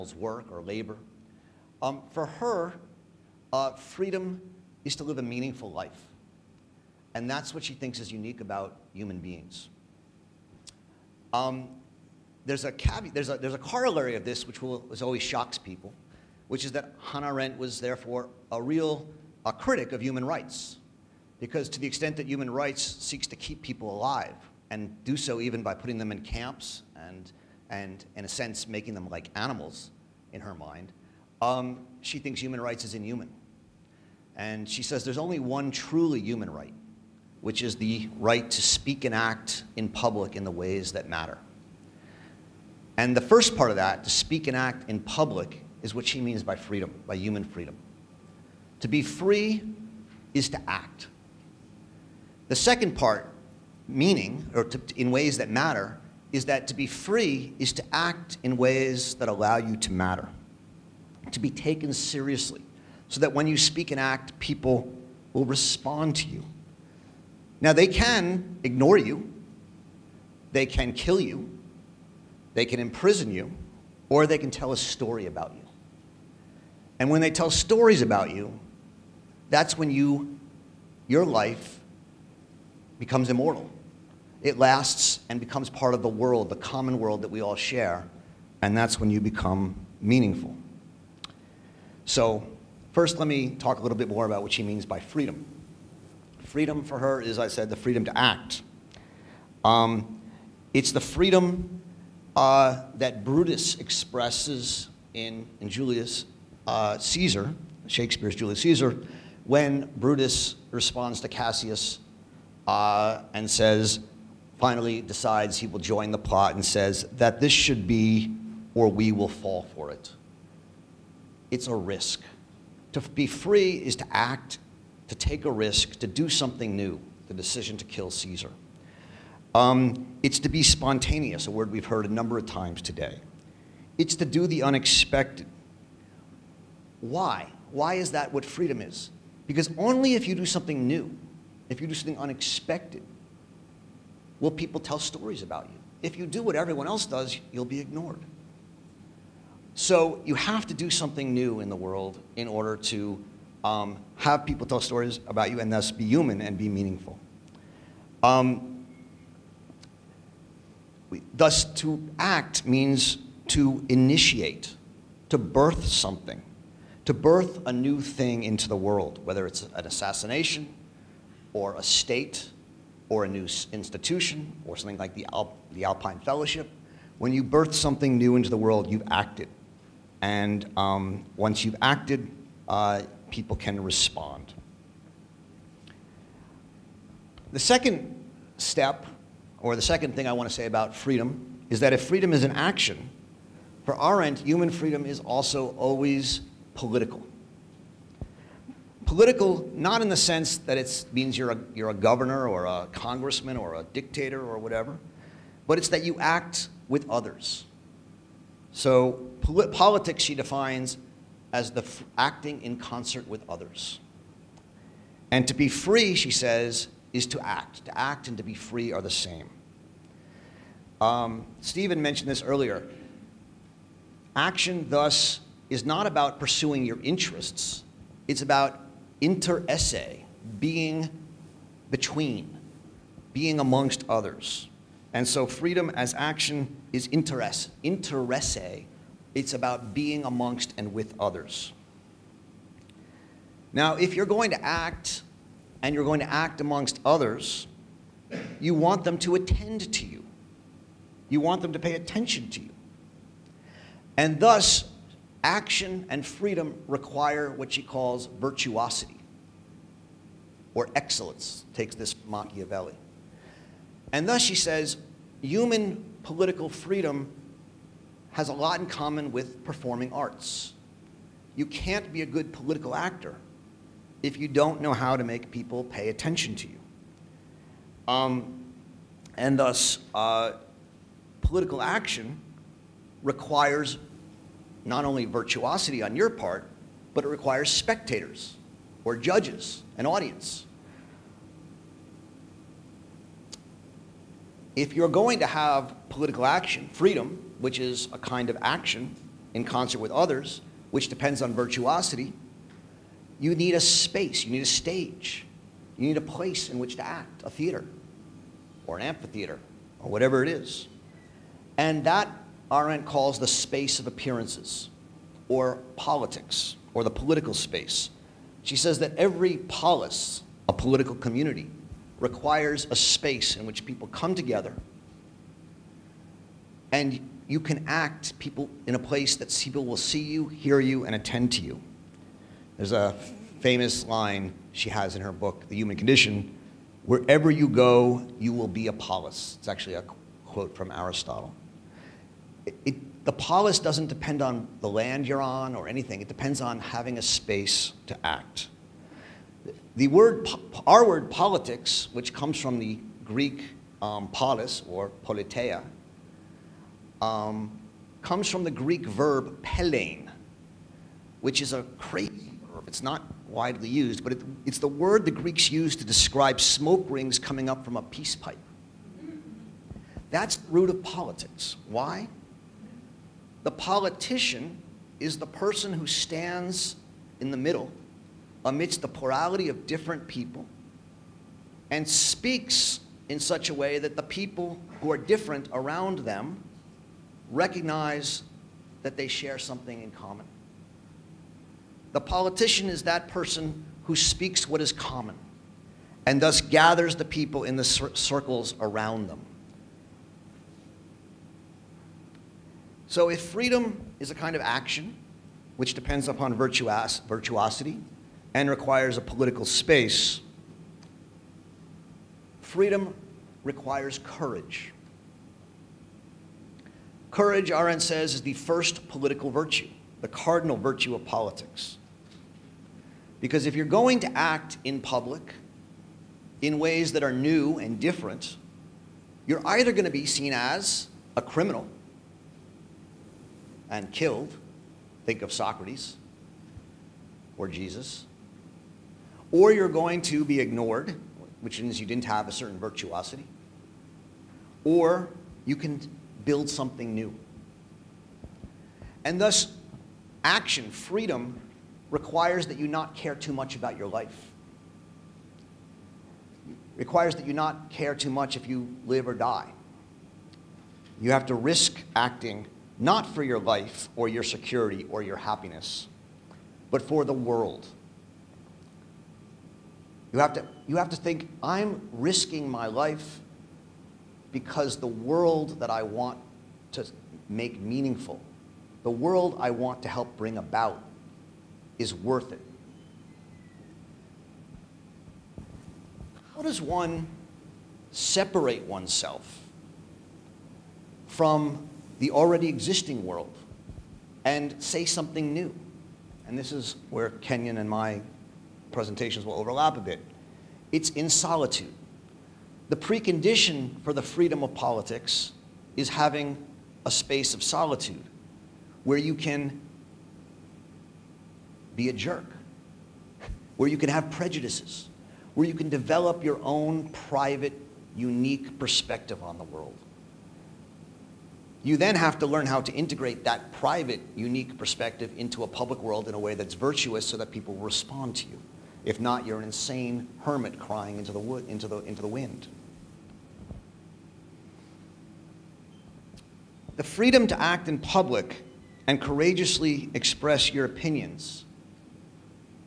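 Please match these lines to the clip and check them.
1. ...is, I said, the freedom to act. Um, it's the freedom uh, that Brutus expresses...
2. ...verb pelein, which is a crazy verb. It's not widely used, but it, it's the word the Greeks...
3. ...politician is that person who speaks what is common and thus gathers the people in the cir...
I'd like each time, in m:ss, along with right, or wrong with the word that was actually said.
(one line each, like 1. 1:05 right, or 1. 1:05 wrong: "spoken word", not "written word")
1. 1:37 right
2. 5:59 right
3. 6:32 right.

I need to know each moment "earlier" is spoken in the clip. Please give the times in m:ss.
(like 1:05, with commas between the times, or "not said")
3:42.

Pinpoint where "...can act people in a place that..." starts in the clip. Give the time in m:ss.
5:27.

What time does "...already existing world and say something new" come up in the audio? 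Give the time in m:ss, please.
8:12.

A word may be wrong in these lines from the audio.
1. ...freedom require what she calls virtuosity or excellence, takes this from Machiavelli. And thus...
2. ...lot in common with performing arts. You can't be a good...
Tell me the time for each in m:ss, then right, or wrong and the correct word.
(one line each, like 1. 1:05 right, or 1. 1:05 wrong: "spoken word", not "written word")
1. 4:16 right
2. 4:28 right.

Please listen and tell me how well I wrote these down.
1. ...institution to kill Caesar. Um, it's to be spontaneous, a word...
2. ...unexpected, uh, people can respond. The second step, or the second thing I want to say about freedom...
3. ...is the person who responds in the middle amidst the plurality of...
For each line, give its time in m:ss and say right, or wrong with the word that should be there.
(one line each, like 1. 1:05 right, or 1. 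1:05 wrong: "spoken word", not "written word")
1. 2:07 wrong: "decision", not "institution"
2. 3:01 wrong: "acted", not "unexpected"
3. 6:15 wrong: "stands", not "responds".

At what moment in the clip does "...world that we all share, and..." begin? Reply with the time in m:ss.
1:26.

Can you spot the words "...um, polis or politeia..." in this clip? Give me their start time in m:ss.
5:54.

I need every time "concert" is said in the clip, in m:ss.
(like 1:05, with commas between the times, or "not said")
3:32, 4:59.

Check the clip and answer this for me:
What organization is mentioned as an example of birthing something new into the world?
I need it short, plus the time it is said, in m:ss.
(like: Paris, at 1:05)
Alpine Fellowship, at 2:55.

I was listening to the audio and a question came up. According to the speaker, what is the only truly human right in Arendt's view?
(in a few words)
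Right to speak and act in public.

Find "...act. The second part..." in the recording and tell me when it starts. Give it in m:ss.
0:50.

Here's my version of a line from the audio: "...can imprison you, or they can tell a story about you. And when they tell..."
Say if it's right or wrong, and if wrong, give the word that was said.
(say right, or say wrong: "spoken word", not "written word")
right.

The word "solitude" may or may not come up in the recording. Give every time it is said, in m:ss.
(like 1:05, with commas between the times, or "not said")
8:21, 8:27.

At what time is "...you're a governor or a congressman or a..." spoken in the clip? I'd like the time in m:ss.
3:21.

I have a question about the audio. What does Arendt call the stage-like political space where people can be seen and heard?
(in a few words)
Space of appearances.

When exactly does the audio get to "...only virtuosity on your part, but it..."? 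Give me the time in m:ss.
4:45.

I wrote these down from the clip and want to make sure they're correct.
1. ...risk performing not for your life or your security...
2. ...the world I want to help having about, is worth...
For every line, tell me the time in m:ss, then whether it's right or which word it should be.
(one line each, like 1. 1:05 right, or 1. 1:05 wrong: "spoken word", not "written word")
1. 7:41 wrong: "acting", not "performing"
2. 7:59 wrong: "bring", not "having".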